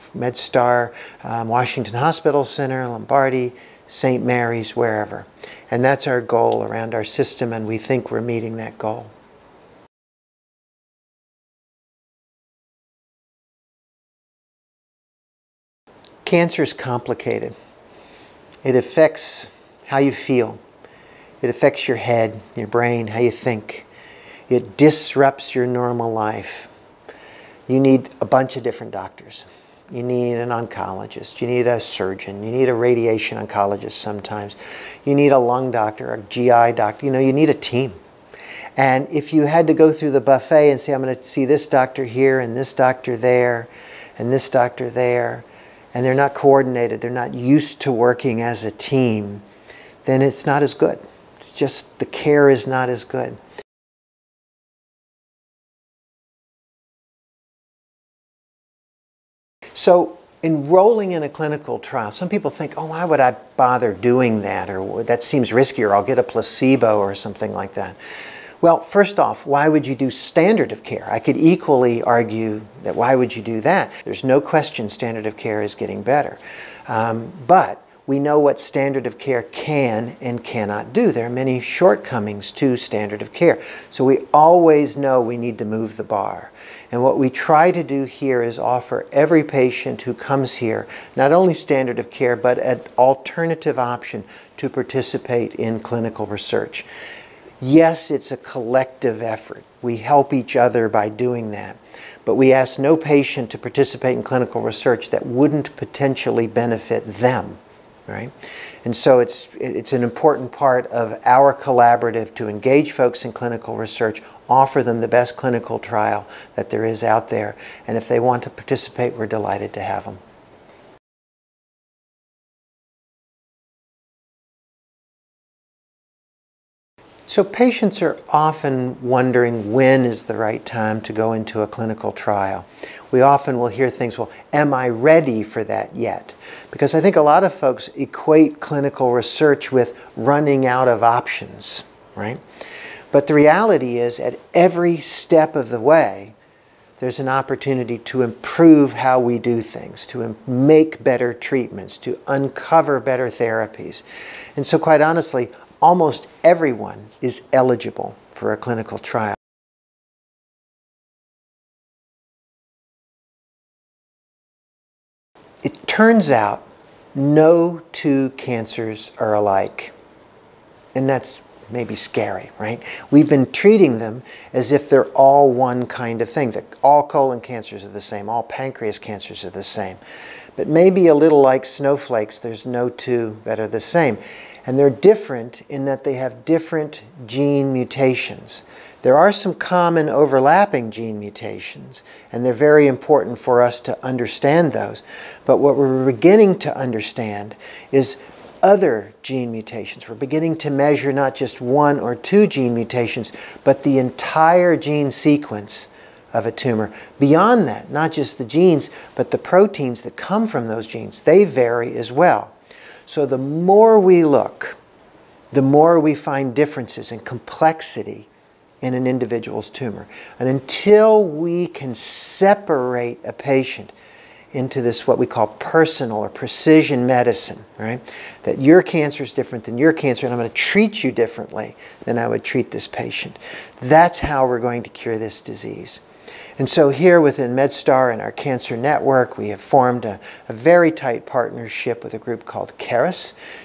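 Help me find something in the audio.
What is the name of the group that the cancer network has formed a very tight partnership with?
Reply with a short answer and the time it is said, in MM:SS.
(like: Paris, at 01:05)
CARIS, at 04:02.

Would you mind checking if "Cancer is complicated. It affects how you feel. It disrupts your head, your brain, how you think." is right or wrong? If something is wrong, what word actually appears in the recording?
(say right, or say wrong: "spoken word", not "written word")
wrong: "affects", not "disrupts".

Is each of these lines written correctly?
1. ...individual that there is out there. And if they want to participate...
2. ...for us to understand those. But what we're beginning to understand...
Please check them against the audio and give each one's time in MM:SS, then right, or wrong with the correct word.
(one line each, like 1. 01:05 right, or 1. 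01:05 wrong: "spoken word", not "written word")
1. 01:55 wrong: "trial", not "individual"
2. 03:13 right.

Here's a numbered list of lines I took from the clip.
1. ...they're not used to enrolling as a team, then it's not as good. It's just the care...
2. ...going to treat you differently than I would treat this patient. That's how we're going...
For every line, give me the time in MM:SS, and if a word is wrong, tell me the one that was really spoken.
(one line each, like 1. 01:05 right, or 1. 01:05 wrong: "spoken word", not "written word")
1. 00:47 wrong: "working", not "enrolling"
2. 03:50 right.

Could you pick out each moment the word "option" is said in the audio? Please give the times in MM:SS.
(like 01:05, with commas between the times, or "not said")
01:33, 02:21.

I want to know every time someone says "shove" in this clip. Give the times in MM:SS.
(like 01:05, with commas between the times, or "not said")
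not said.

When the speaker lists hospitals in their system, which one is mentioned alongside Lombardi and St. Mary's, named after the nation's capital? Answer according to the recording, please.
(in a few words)
Washington Hospital Center.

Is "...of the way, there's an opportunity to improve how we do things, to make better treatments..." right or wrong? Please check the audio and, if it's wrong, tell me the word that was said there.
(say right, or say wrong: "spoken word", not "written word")
right.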